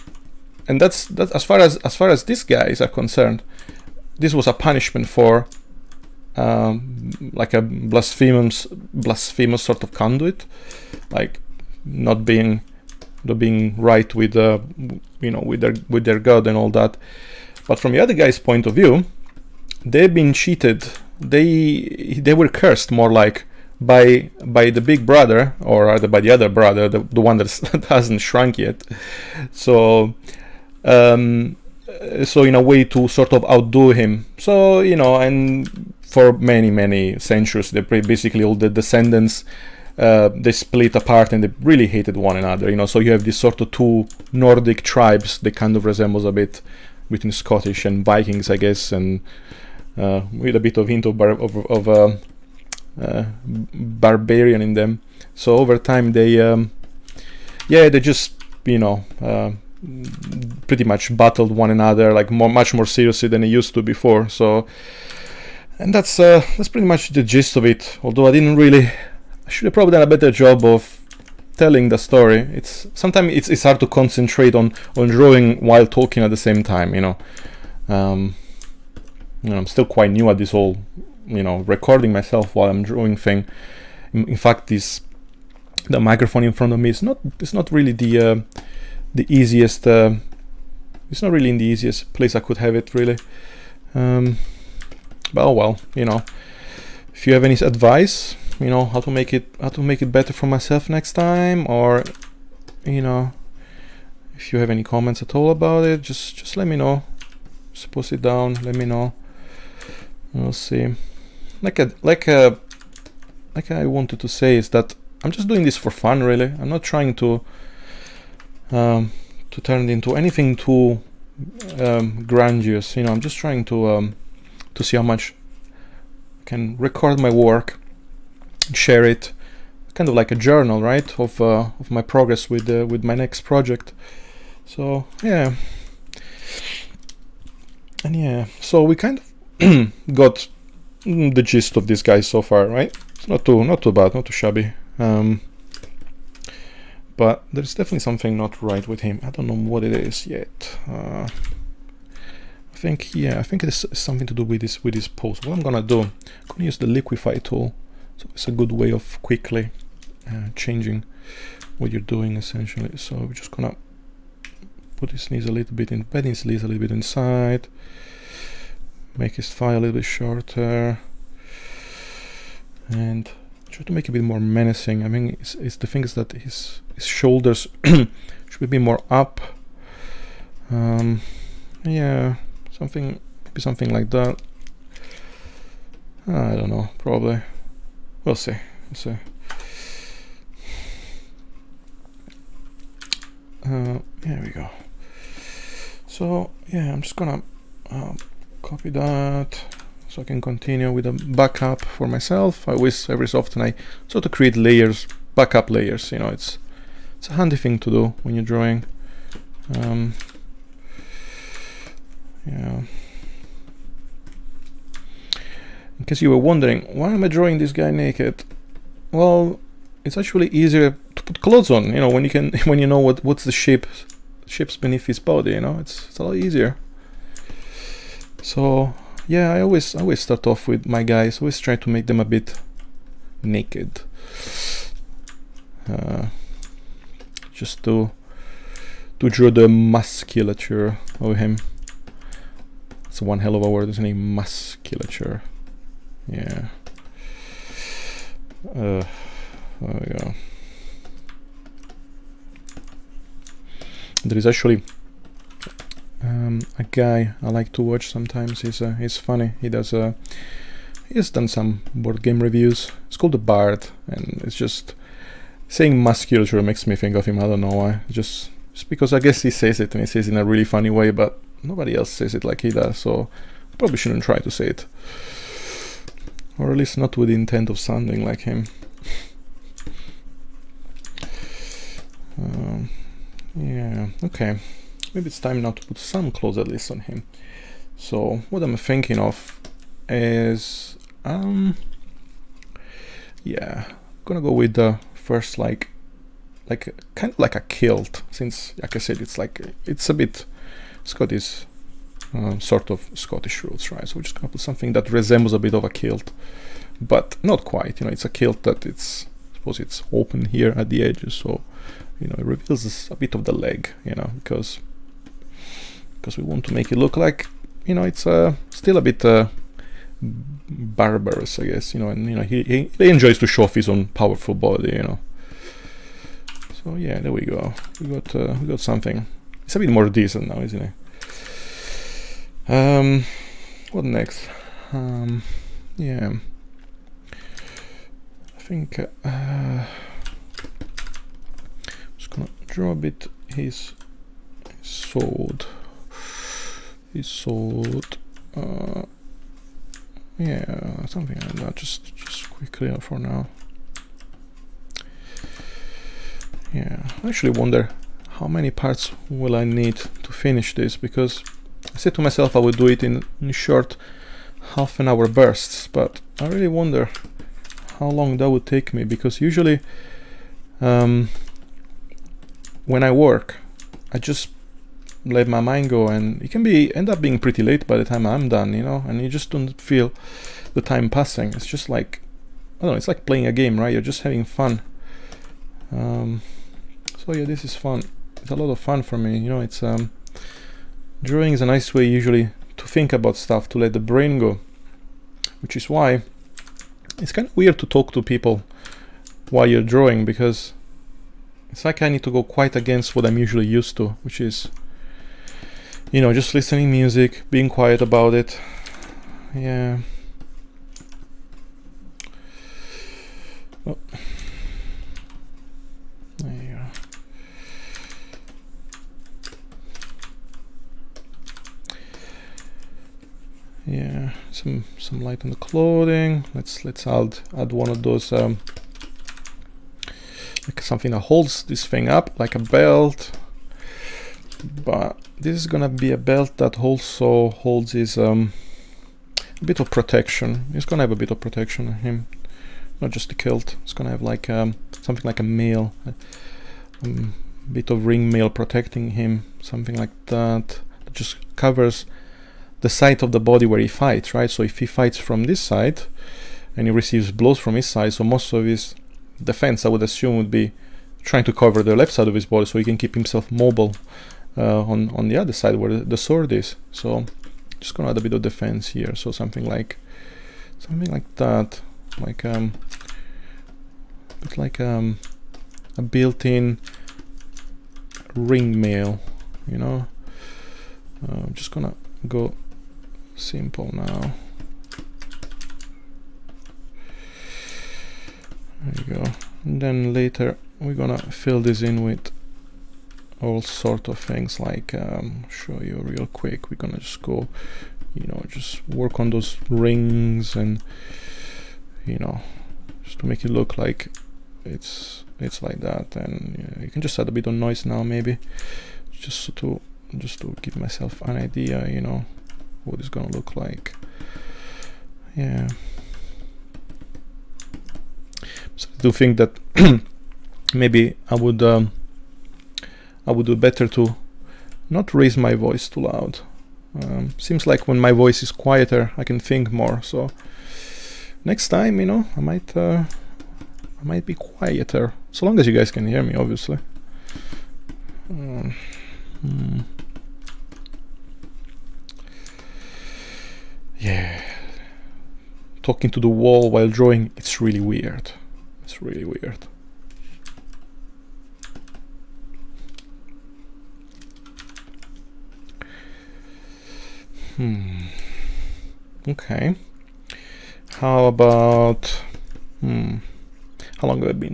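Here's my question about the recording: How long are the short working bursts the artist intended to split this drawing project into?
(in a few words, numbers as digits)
half an hour.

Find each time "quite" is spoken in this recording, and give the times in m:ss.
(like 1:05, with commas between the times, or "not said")
1:19, 5:07, 6:42.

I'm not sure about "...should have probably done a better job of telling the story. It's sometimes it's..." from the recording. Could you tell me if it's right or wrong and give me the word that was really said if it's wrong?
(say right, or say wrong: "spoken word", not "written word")
right.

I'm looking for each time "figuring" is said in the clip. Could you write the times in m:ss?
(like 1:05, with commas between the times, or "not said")
not said.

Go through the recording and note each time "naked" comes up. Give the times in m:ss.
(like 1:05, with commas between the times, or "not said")
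3:37, 3:53.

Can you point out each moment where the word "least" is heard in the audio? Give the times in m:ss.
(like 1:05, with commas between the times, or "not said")
4:36, 4:46.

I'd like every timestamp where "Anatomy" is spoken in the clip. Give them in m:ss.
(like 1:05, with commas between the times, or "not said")
not said.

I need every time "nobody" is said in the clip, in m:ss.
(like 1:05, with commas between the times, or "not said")
4:31.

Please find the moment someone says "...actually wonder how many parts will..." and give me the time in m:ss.
5:57.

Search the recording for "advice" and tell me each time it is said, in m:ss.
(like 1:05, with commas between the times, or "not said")
1:37.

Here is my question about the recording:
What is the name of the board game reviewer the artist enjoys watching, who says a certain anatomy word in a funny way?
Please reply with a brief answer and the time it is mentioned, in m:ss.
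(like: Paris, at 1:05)
the Bard, at 4:23.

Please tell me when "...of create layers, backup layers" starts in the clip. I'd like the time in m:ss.
3:24.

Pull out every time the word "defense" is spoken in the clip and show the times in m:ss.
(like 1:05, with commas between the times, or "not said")
7:39, 7:48.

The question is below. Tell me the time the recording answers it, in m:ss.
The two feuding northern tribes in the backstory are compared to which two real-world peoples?
0:47.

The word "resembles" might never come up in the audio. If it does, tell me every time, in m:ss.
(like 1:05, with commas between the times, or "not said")
0:45, 5:05.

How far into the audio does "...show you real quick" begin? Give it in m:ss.
8:15.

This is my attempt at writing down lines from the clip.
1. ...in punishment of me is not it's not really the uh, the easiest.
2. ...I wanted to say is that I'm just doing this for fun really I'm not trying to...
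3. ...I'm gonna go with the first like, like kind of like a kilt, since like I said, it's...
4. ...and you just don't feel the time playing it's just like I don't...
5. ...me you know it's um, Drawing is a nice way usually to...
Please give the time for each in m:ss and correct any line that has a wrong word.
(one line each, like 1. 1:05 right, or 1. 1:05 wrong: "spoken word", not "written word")
1. 1:26 wrong: "front", not "punishment"
2. 1:53 right
3. 4:53 right
4. 6:19 wrong: "passing", not "playing"
5. 6:29 right.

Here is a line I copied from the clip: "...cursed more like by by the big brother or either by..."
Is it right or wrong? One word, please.
right.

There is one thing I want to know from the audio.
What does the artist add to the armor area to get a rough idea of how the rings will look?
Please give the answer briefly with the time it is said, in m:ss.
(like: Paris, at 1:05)
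noise, at 8:27.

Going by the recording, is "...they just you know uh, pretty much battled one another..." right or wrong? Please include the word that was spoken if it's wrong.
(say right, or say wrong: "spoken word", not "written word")
right.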